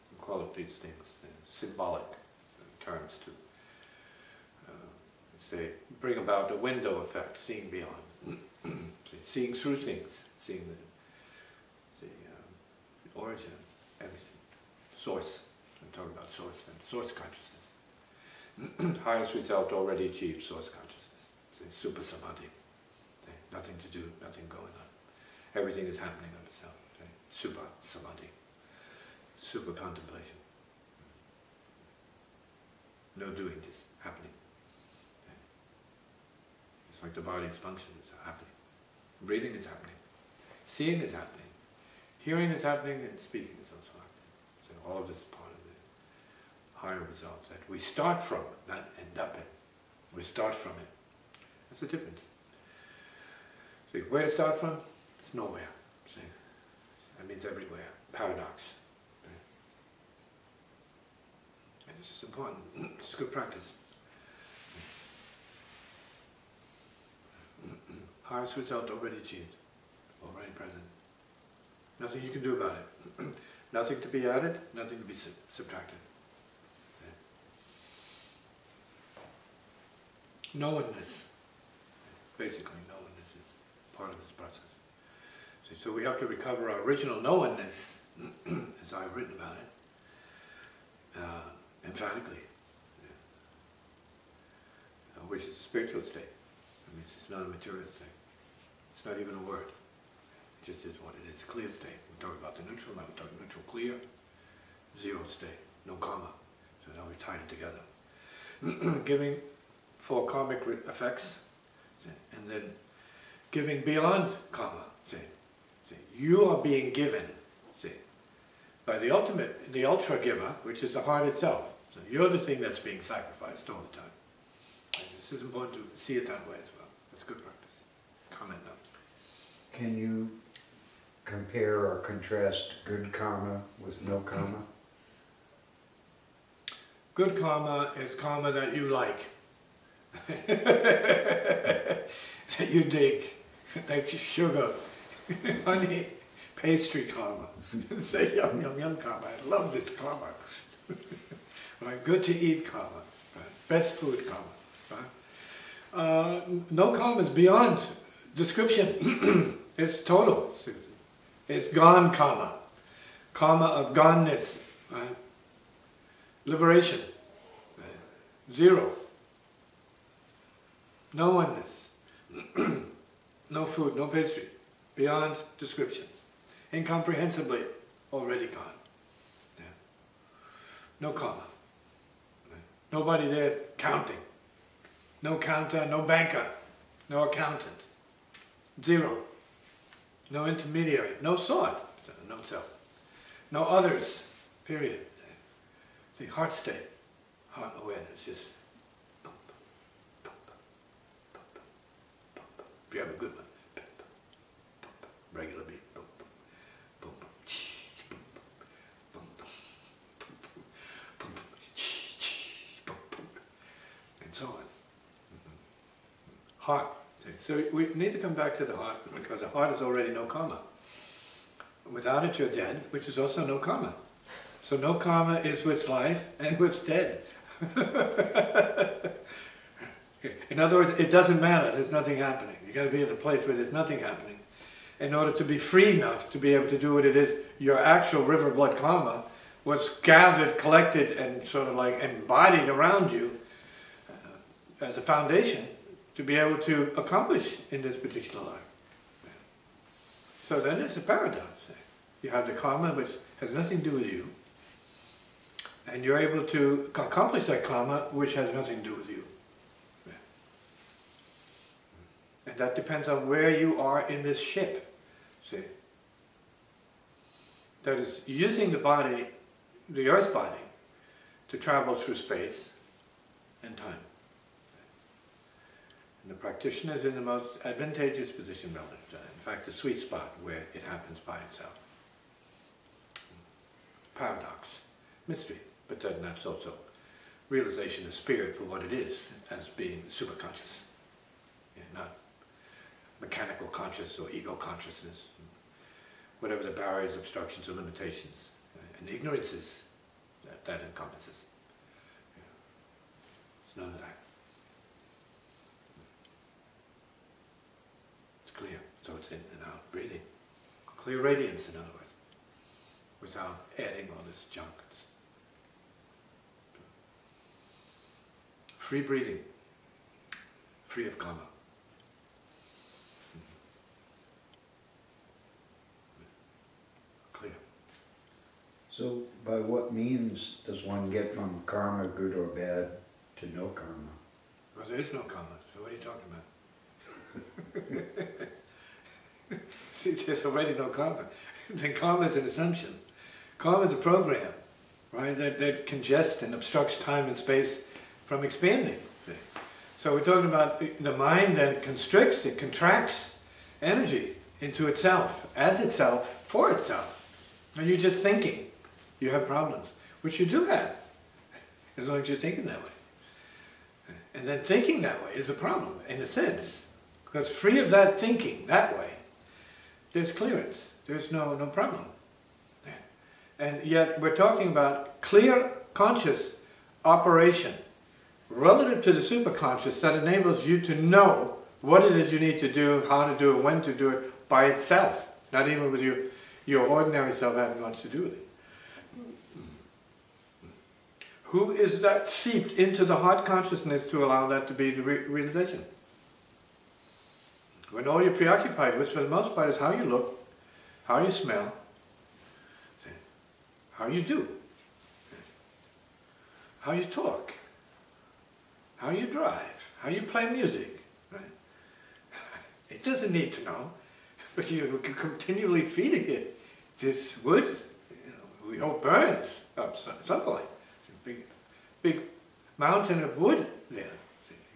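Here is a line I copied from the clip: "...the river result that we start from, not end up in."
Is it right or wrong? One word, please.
wrong.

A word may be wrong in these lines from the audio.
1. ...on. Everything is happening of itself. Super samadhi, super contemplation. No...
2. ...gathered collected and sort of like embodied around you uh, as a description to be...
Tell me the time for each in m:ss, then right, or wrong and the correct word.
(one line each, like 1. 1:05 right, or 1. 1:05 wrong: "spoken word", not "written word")
1. 0:24 right
2. 3:59 wrong: "foundation", not "description".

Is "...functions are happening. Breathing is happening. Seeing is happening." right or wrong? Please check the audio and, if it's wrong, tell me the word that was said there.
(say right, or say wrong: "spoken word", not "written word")
right.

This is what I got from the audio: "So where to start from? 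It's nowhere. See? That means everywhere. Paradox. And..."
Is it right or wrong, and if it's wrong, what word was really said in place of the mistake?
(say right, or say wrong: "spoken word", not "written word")
right.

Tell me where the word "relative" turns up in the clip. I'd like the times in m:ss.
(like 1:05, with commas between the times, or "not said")
4:38, 6:18.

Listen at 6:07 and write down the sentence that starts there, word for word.
Because free of that thinking, that way, there's clearance.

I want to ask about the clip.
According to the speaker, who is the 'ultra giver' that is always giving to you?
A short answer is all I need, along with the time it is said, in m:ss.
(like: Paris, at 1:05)
The heart itself, at 2:00.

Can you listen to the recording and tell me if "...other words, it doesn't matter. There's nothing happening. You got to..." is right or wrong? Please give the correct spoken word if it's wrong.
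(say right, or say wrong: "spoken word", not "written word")
right.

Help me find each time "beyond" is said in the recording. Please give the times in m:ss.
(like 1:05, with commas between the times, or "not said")
0:07, 1:53, 2:37, 2:54.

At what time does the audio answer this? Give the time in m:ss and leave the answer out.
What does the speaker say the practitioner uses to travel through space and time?
4:29.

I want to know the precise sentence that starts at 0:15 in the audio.
I'm talking about source then, source consciousness.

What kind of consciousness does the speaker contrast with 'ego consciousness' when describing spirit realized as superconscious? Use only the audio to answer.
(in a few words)
Mechanical conscious.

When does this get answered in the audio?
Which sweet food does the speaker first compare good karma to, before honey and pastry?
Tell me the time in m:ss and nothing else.
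2:24.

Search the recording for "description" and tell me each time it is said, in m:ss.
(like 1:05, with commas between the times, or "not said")
2:38, 2:55.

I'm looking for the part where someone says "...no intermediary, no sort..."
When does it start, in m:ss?
3:10.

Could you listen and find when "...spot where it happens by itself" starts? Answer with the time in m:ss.
4:39.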